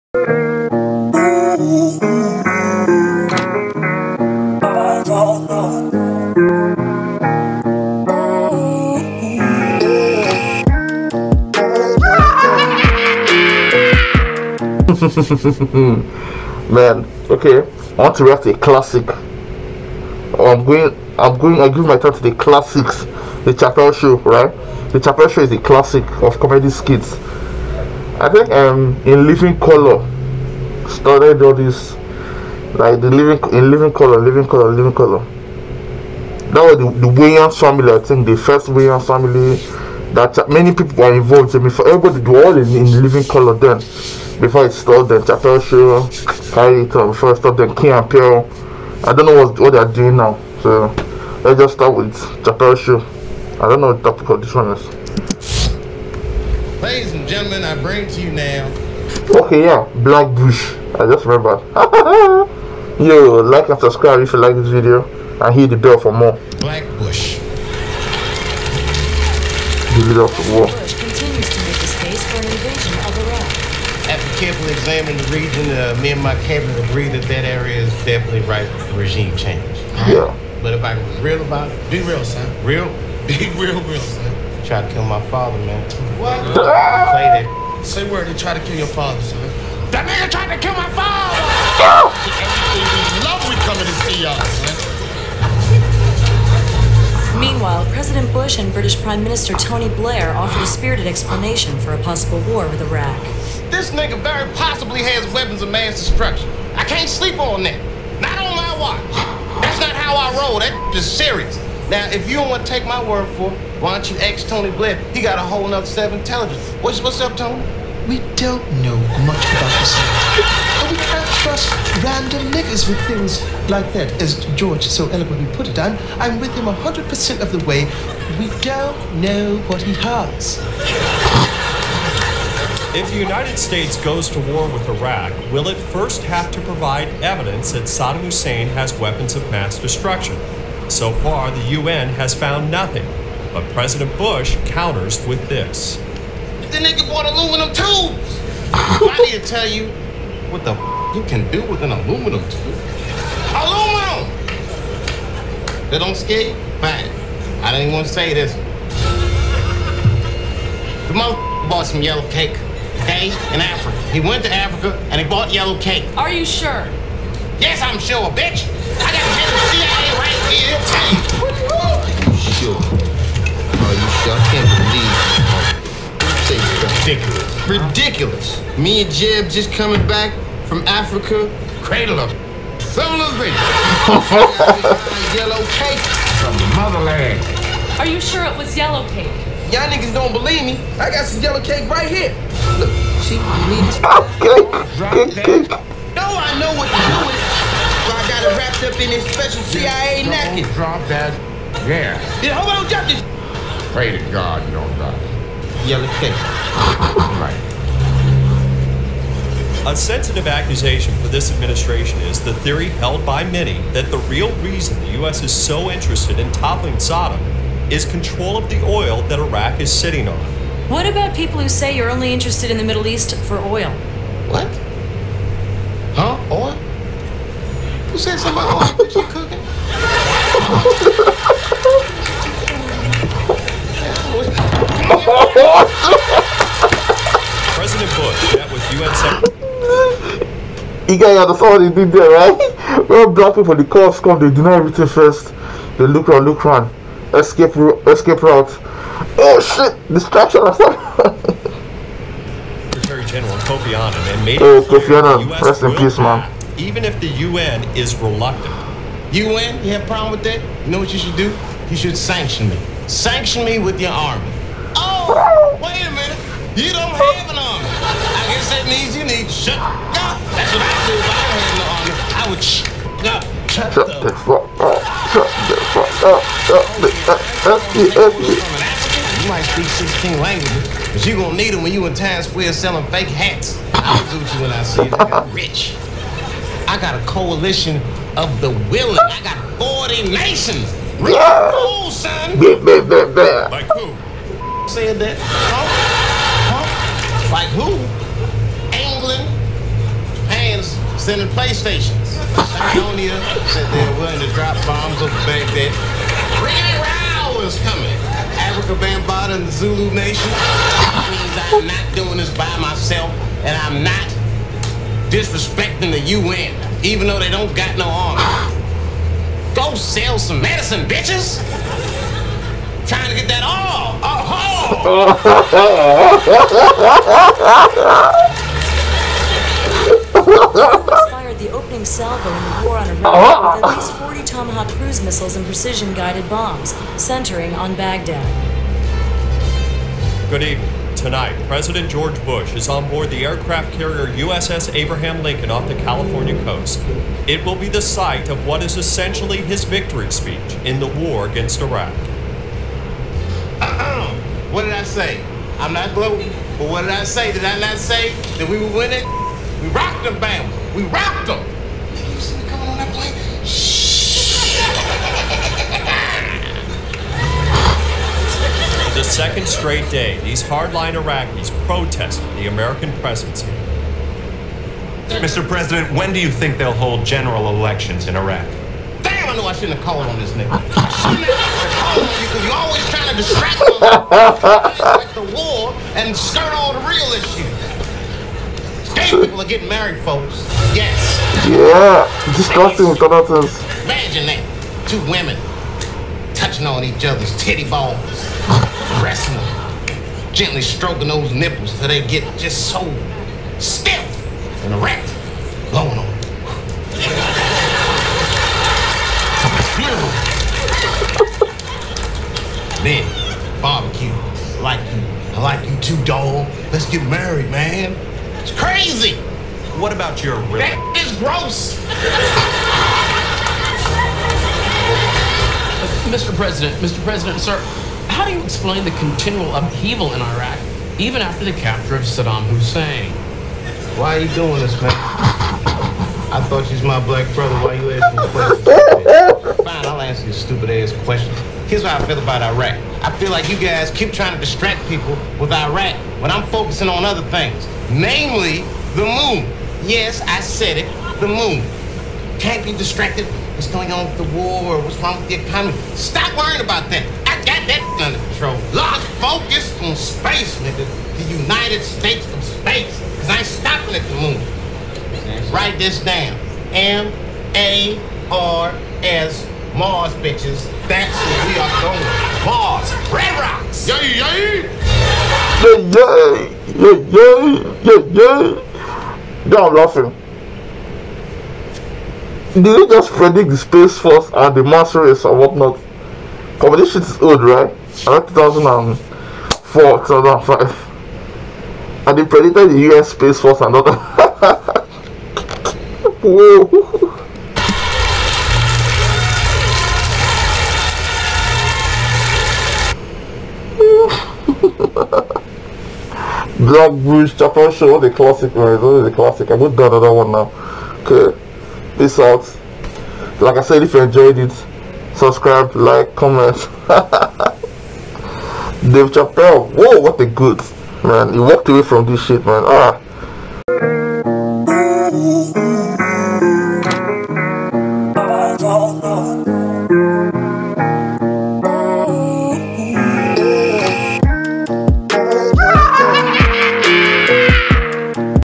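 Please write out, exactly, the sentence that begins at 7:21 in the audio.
Here's how I feel about Iraq.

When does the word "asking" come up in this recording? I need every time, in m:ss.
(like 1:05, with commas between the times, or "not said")
7:18.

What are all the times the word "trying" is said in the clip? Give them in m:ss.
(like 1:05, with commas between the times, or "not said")
5:23, 6:23, 7:24.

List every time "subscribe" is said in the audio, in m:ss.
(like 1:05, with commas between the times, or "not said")
1:03, 8:35.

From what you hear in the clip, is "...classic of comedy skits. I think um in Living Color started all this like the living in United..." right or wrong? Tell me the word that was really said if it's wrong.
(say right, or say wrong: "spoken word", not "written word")
wrong: "Living", not "United".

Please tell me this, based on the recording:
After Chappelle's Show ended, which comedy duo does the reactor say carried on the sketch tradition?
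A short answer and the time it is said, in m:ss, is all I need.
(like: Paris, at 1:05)
Key and Peele, at 0:47.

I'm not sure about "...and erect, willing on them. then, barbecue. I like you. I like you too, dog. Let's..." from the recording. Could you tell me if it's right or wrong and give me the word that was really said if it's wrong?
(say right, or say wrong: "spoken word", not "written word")
wrong: "blowing", not "willing".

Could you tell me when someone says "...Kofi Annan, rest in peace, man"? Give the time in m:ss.
4:14.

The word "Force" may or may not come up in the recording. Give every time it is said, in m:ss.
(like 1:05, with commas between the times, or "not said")
8:04, 8:13.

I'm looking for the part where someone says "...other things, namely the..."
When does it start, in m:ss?
7:27.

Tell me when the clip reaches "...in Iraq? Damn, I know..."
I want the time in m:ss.
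6:18.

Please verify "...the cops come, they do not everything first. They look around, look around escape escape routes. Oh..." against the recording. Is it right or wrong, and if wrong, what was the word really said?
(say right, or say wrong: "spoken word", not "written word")
right.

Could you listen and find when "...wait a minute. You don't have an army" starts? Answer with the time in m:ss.
4:25.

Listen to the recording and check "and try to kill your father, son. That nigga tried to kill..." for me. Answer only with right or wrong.
right.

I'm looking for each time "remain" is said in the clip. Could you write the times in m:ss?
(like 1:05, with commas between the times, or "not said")
not said.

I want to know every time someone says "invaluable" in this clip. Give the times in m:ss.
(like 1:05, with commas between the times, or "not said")
not said.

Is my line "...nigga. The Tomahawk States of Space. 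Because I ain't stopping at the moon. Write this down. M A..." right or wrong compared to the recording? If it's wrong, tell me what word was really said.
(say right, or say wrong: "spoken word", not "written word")
wrong: "United", not "Tomahawk".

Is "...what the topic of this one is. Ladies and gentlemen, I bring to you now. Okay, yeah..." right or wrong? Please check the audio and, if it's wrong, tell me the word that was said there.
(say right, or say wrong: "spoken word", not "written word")
right.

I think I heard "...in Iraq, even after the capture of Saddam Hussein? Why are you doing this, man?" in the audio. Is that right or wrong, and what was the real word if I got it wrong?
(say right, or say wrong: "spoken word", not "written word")
right.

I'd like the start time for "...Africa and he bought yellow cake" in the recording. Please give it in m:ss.
2:44.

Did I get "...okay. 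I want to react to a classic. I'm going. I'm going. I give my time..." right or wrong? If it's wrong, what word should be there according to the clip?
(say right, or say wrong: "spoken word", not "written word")
right.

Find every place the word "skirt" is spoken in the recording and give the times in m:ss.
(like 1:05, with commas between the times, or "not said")
6:26.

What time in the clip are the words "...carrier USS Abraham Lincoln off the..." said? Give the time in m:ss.
5:43.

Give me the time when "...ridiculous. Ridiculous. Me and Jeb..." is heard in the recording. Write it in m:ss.
2:56.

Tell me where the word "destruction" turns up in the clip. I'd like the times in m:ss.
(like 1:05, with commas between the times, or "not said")
1:45, 2:19.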